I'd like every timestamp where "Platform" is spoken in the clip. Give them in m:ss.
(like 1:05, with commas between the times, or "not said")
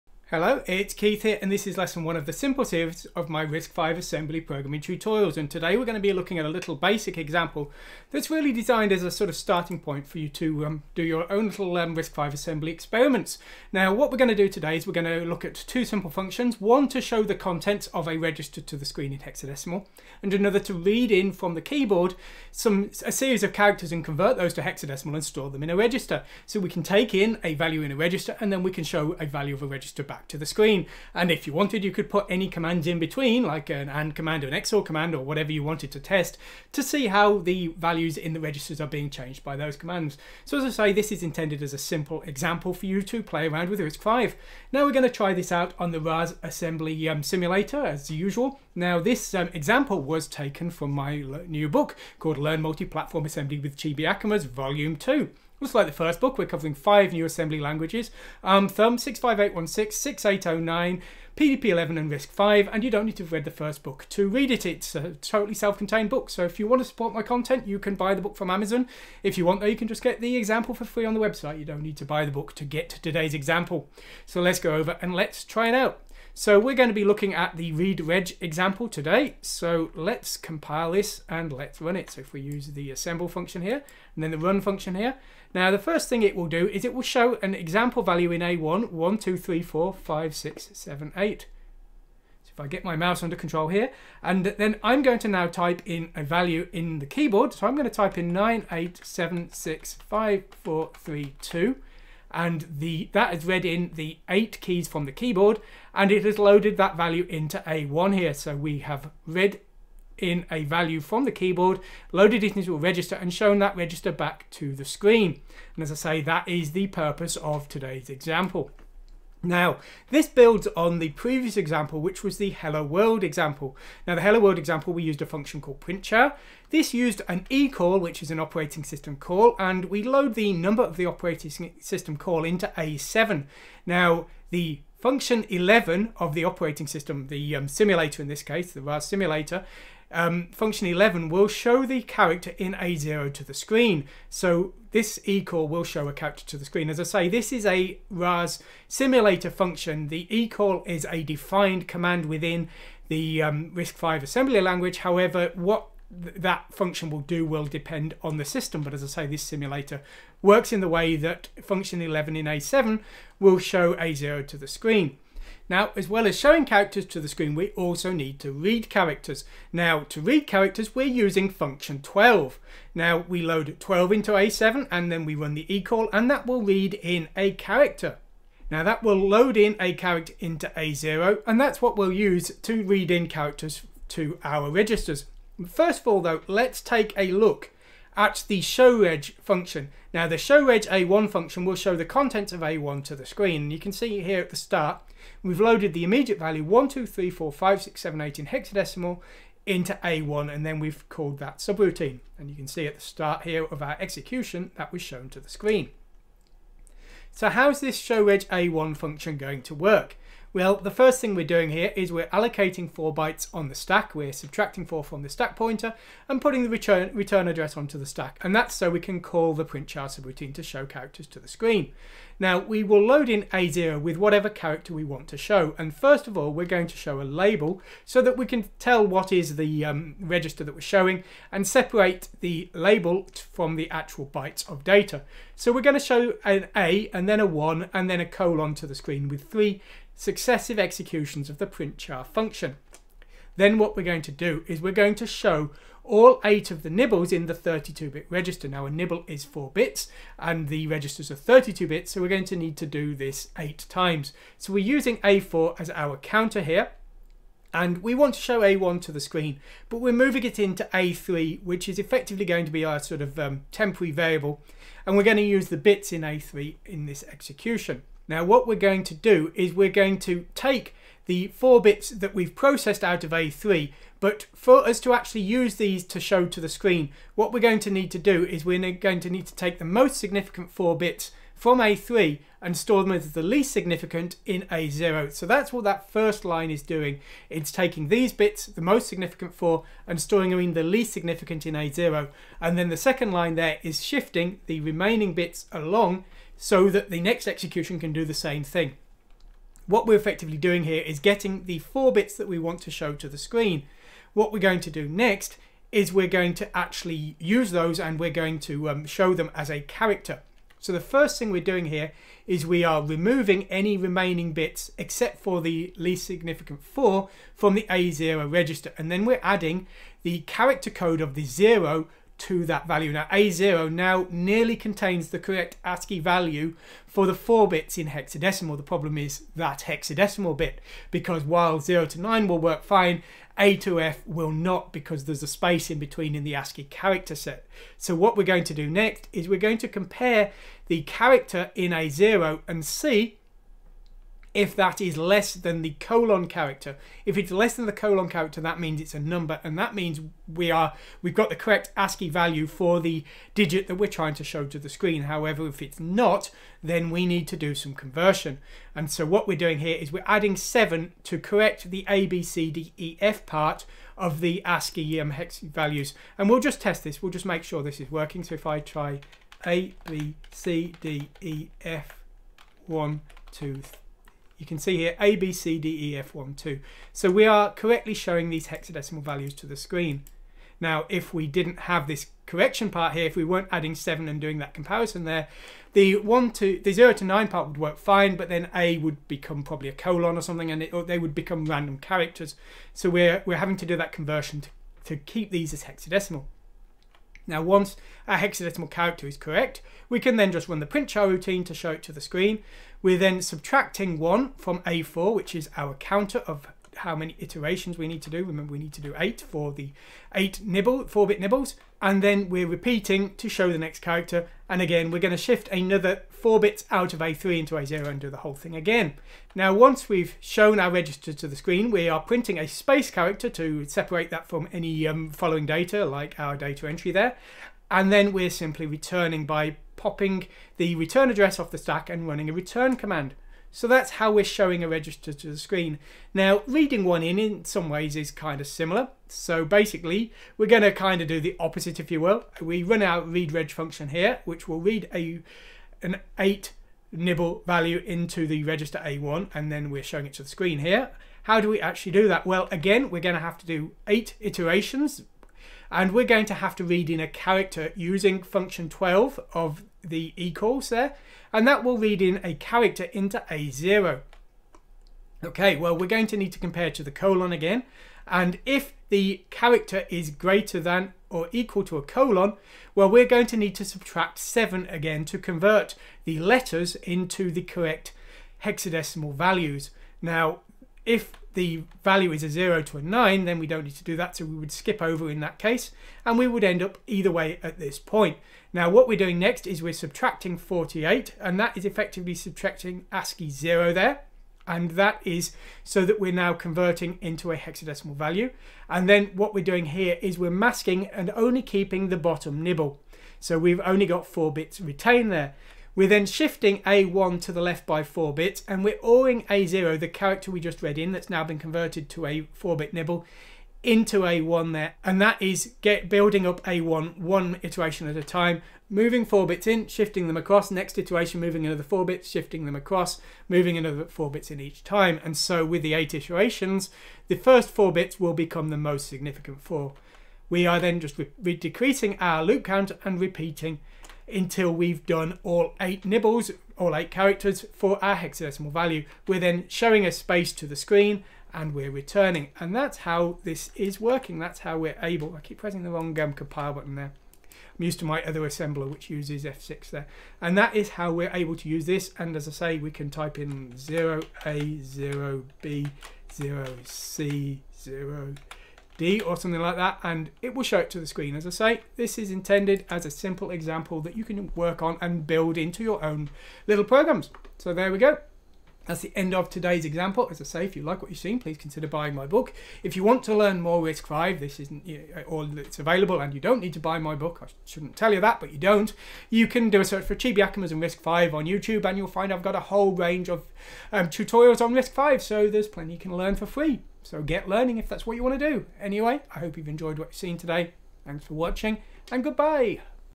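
0:52.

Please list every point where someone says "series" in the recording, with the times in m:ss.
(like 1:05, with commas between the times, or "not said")
0:02, 0:23.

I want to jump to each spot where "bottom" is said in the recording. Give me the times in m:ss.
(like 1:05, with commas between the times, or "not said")
8:22.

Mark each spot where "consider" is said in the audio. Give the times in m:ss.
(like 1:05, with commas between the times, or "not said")
9:31.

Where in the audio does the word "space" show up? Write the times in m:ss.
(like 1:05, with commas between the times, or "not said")
5:35, 7:02, 9:00.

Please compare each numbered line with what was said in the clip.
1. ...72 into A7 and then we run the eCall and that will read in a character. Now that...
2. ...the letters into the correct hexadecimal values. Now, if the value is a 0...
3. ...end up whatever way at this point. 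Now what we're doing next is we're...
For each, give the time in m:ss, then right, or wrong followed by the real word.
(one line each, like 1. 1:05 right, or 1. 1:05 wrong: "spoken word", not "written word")
1. 2:53 wrong: "12", not "72"
2. 7:56 right
3. 8:06 wrong: "either", not "whatever".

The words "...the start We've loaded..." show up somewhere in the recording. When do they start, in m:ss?
3:14.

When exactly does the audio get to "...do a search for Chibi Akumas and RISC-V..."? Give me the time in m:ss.
9:39.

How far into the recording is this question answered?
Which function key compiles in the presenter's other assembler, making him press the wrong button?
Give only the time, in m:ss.
9:09.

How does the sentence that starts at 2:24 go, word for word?
So this eCall will show a character to the screen.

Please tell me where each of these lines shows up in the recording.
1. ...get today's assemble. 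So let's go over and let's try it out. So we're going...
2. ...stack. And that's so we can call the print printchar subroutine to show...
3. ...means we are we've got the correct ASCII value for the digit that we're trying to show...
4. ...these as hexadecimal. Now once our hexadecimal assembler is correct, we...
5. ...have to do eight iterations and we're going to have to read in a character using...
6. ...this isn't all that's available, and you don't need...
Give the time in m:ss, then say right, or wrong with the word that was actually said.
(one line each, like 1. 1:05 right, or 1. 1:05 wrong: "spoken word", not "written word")
1. 1:12 wrong: "example", not "assemble"
2. 3:38 right
3. 5:49 right
4. 6:35 wrong: "character", not "assembler"
5. 7:33 right
6. 9:34 right.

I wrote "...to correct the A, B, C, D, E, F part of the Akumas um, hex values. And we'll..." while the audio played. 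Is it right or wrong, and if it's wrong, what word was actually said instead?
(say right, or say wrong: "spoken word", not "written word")
wrong: "ASCII", not "Akumas".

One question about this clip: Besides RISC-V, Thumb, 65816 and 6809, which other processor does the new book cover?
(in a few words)
PDP 11.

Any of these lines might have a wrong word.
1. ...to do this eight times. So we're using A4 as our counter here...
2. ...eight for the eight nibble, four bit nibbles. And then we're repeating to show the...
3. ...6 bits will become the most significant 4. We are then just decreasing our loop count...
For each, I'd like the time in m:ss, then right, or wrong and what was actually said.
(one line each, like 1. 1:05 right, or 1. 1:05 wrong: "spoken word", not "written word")
1. 4:12 right
2. 6:49 right
3. 8:47 wrong: "4", not "6".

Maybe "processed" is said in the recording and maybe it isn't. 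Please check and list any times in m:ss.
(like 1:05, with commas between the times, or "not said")
4:32.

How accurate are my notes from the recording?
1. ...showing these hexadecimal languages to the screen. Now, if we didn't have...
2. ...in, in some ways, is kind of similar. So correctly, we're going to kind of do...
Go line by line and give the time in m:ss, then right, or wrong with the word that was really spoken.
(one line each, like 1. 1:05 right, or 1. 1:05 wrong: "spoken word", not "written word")
1. 6:18 wrong: "values", not "languages"
2. 7:17 wrong: "basically", not "correctly".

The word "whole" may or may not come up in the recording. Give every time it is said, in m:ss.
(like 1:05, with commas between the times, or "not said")
6:58, 9:42.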